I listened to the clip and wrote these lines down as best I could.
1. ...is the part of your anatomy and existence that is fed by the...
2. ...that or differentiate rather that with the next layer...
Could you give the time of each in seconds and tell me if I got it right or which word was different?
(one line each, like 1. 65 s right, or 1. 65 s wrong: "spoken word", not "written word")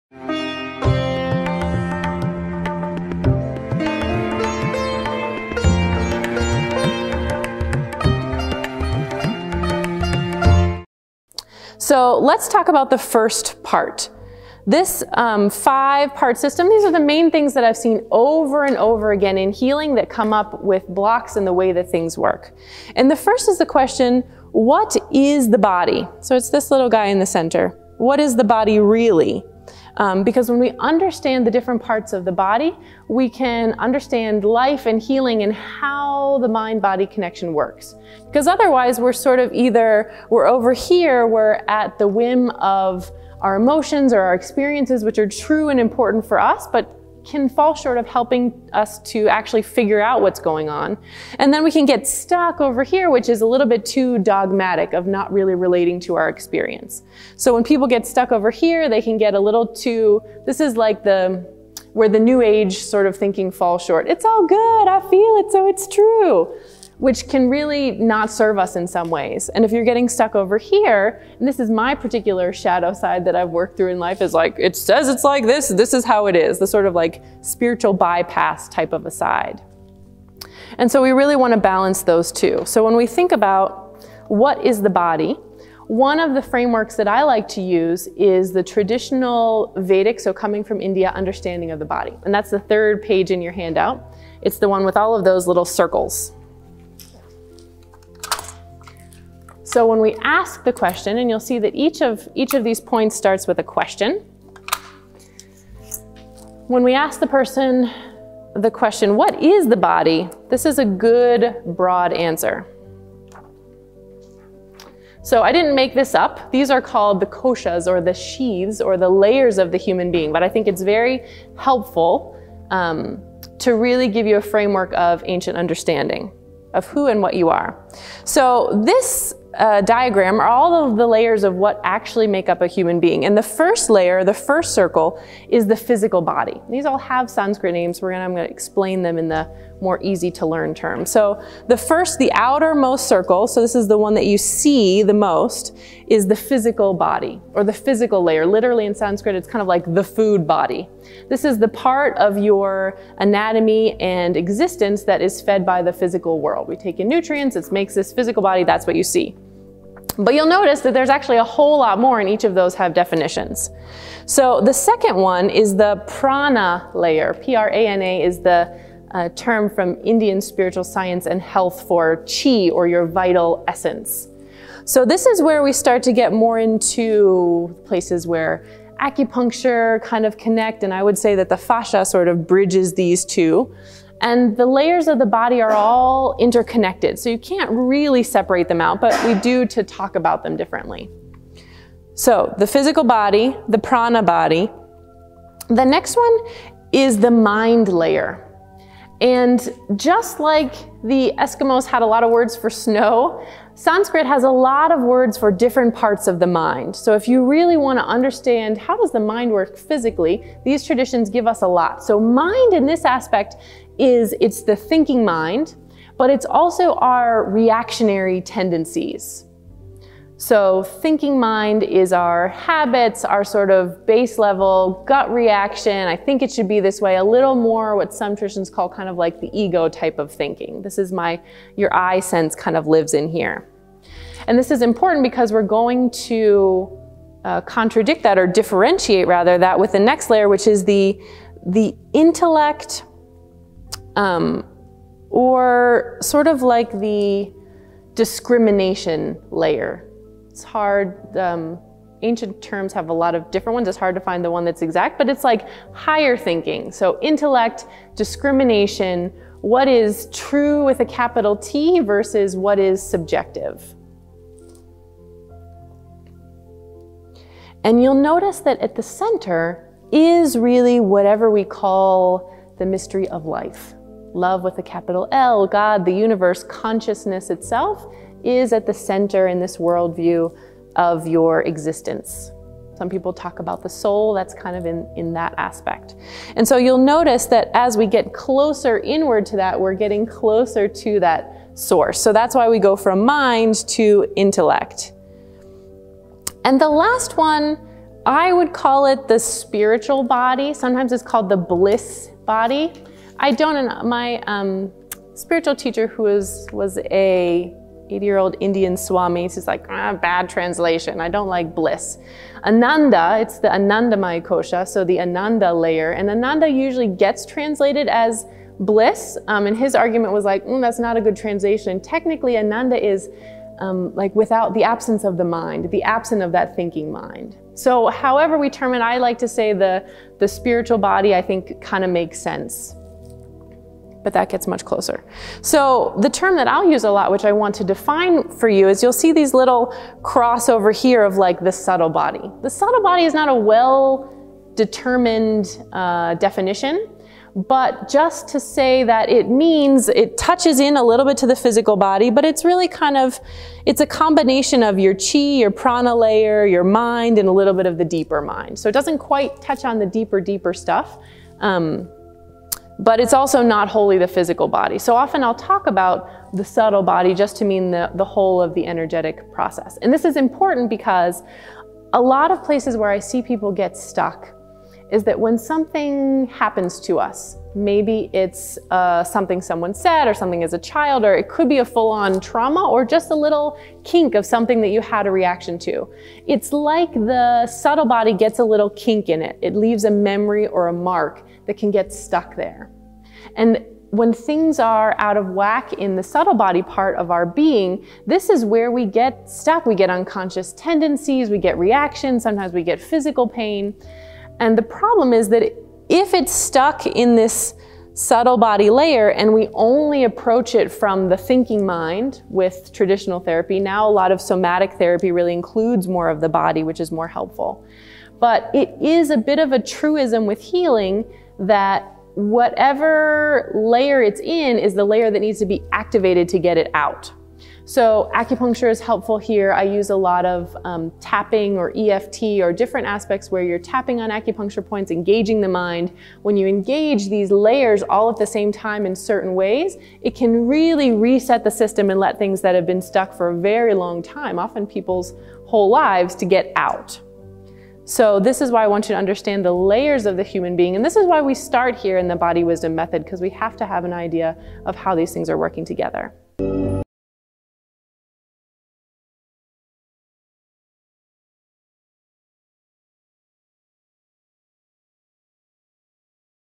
1. 151 s right
2. 238 s right.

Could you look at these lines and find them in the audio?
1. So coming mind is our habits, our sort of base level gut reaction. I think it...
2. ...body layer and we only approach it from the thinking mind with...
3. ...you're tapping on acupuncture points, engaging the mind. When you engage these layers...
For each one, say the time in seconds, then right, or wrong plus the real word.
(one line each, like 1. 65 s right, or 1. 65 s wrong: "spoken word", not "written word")
1. 220 s wrong: "thinking", not "coming"
2. 408 s right
3. 433 s right.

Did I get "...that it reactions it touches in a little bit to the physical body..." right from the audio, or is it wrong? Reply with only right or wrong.
wrong.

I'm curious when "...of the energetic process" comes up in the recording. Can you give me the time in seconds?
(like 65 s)
368 s.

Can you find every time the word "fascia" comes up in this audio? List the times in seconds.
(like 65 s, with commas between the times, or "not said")
181 s.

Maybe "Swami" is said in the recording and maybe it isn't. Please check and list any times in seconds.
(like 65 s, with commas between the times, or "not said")
308 s.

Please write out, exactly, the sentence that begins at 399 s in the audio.
We get unconscious tendencies, we get reactions, sometimes we get physical pain.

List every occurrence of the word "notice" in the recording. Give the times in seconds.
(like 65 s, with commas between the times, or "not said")
160 s, 268 s, 286 s.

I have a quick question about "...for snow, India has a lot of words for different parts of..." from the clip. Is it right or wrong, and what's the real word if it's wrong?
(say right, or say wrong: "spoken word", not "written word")
wrong: "Sanskrit", not "India".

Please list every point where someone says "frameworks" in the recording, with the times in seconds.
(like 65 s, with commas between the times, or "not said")
86 s, 124 s.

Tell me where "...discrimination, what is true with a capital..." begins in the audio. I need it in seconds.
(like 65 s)
258 s.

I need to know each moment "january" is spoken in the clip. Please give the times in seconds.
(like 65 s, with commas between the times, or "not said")
not said.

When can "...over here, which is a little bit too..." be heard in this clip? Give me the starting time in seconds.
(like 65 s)
52 s.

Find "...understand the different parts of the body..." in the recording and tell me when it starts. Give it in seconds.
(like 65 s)
30 s.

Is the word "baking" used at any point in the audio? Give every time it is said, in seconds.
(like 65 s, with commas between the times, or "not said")
not said.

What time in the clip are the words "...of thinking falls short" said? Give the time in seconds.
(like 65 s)
63 s.